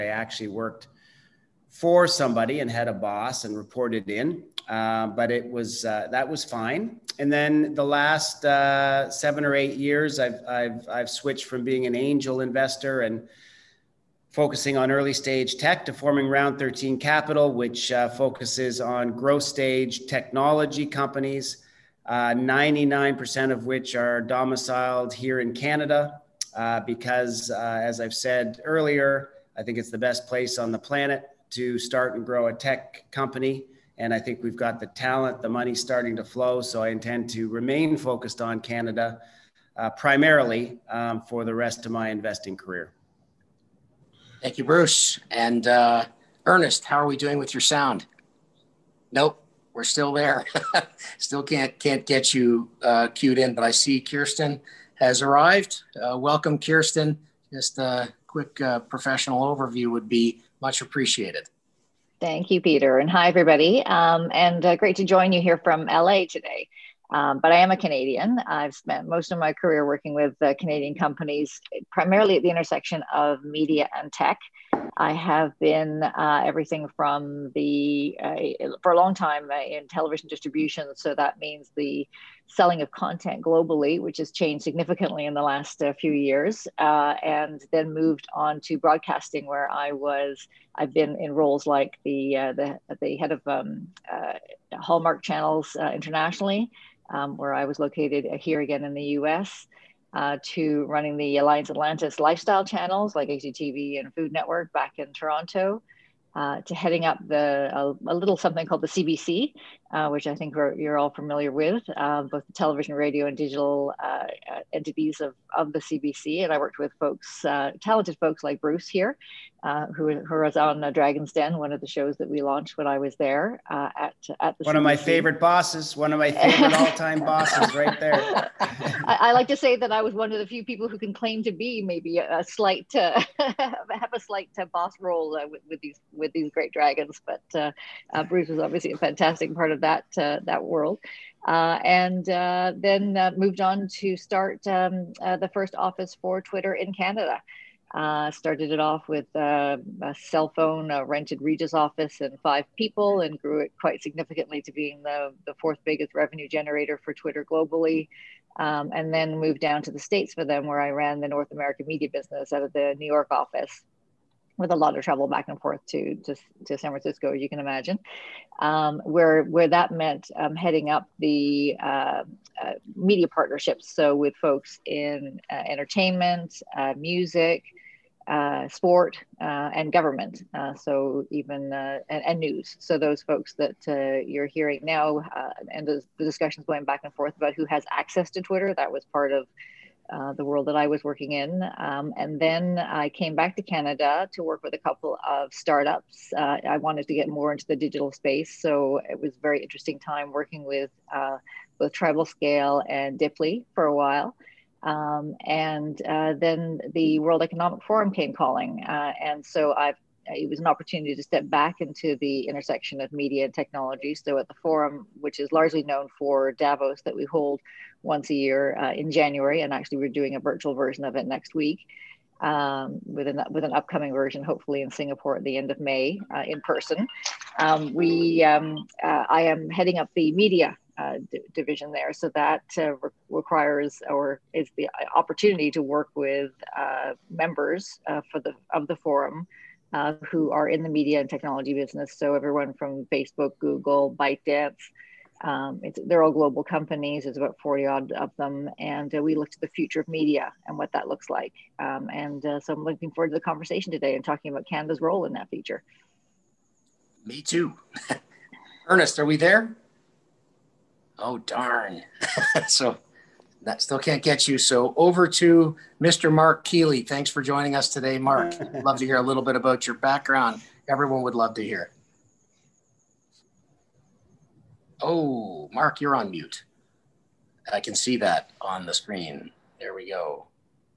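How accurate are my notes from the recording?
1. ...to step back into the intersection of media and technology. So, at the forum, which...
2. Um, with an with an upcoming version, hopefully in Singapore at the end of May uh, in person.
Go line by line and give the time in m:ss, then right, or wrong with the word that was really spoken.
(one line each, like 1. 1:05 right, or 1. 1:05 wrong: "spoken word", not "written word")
1. 3:31 right
2. 3:42 right.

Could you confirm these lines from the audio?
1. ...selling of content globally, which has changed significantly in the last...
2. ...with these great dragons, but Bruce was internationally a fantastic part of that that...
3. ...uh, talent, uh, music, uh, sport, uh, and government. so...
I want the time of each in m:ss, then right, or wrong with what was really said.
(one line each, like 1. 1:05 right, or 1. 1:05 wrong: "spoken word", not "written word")
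1. 1:22 right
2. 2:16 wrong: "obviously", not "internationally"
3. 2:55 wrong: "entertainment", not "talent".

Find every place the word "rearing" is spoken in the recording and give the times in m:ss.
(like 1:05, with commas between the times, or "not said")
not said.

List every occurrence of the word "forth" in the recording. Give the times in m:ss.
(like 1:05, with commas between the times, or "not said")
2:45, 3:07.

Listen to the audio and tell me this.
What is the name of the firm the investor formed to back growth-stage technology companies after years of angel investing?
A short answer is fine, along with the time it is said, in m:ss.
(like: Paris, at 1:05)
Round 13 Capital, at 0:16.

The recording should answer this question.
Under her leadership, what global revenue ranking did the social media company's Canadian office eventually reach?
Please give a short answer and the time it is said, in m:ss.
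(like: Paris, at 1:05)
fourth, at 2:35.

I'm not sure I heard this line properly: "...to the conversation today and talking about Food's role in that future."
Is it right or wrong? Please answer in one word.
wrong.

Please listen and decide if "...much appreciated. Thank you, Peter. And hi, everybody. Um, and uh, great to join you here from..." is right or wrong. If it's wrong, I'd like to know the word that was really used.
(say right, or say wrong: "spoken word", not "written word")
right.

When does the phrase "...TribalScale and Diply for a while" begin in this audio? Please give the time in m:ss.
3:21.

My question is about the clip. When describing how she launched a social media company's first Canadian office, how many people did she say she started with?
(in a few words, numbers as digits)
5.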